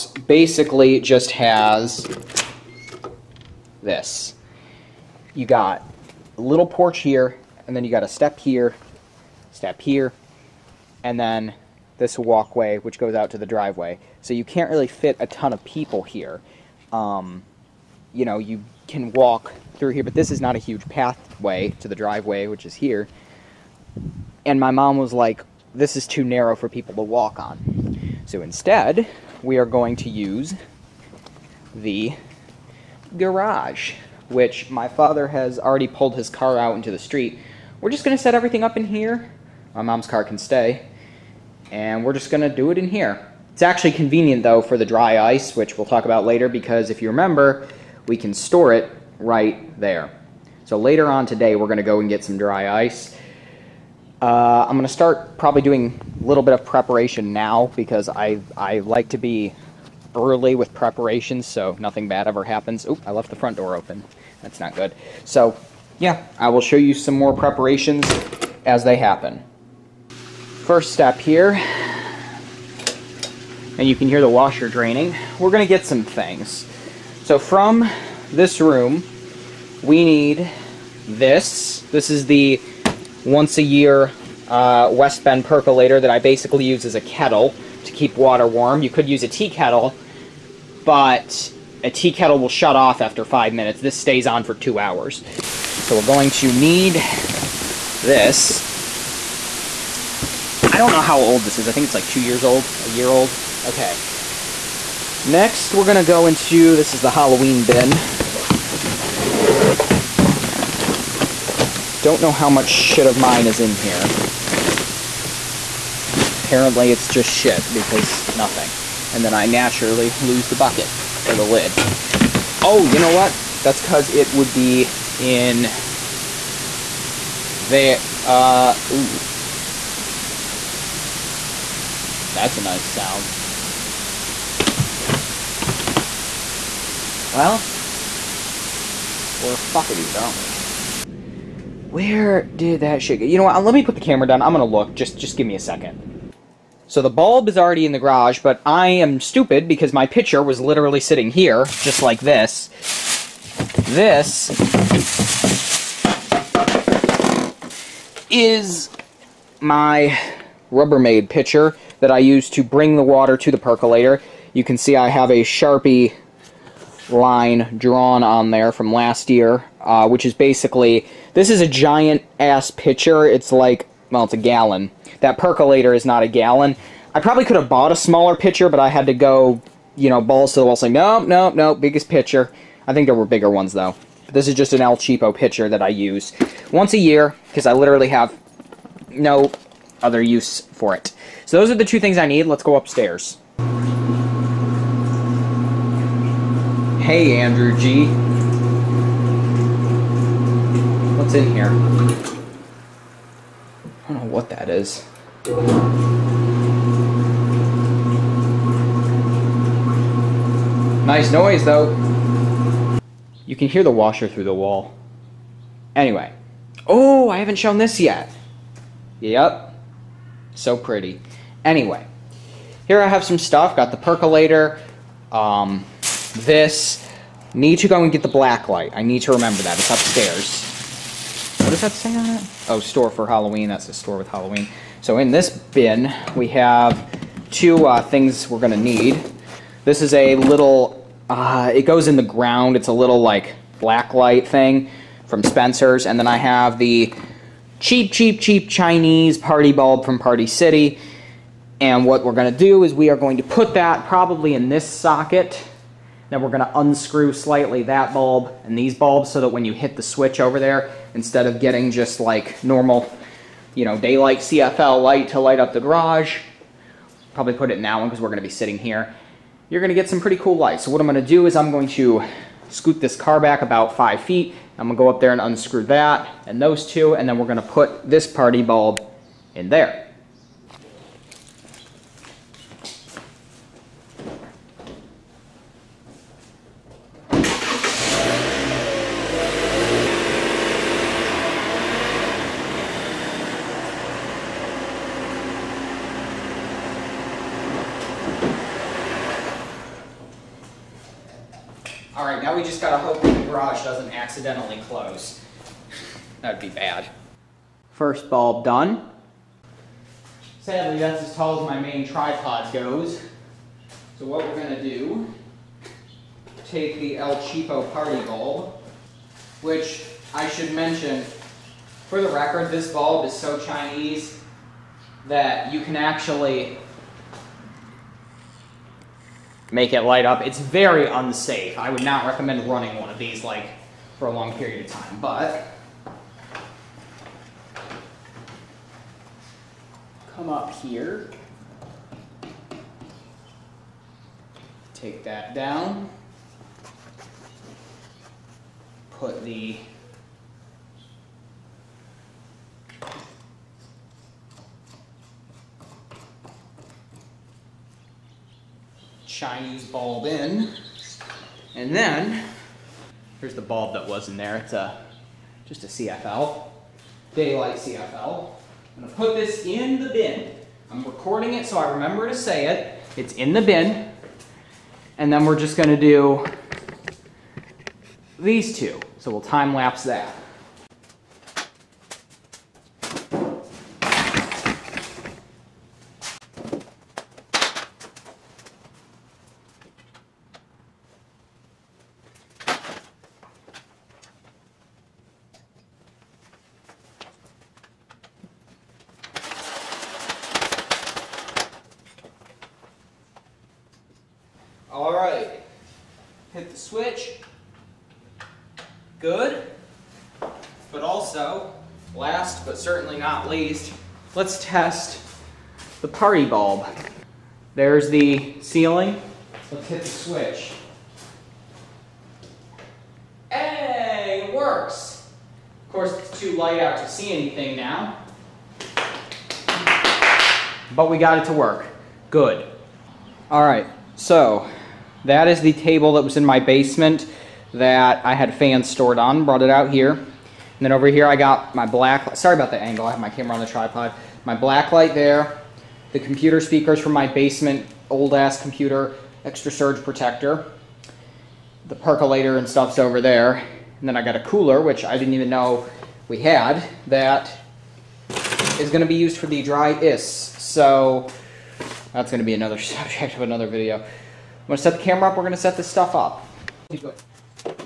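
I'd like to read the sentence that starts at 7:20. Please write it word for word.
And then over here I got my black, sorry about the angle, I have my camera on the tripod.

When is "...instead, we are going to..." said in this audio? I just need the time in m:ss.
0:28.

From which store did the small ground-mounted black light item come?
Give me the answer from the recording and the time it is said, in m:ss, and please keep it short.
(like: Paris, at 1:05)
Spencer's, at 4:05.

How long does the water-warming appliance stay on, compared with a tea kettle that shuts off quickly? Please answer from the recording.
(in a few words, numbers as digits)
2 hours.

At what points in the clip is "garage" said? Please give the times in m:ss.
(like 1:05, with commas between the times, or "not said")
0:33, 2:27, 4:25.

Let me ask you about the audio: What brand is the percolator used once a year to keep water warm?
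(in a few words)
West Bend.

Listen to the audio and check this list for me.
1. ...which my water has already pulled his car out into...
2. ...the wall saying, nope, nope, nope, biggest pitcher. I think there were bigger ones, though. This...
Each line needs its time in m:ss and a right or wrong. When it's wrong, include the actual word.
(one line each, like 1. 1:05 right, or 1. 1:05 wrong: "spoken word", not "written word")
1. 0:34 wrong: "father", not "water"
2. 3:00 right.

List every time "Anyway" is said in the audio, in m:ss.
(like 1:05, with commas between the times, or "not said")
3:35, 3:41.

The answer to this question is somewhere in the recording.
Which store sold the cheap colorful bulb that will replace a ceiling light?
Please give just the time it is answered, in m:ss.
4:10.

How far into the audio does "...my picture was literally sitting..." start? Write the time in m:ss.
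2:29.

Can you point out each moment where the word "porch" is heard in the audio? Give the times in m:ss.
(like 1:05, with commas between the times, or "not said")
0:06.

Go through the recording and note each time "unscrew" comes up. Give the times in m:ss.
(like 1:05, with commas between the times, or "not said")
4:16, 4:35.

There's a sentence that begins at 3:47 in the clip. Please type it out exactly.
Need to go and get the black light.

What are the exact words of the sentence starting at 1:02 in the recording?
Oop, I left the front door open.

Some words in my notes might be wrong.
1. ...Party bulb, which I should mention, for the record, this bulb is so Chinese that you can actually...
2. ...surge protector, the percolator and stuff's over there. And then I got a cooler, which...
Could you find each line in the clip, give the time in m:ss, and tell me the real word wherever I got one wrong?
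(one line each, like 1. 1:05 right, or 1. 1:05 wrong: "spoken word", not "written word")
1. 5:17 right
2. 7:29 right.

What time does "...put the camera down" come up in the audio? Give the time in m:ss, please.
2:23.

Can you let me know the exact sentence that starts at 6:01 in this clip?
And then, here's the bulb that was in there.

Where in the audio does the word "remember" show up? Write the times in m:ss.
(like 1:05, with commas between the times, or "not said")
0:47, 3:49, 6:11.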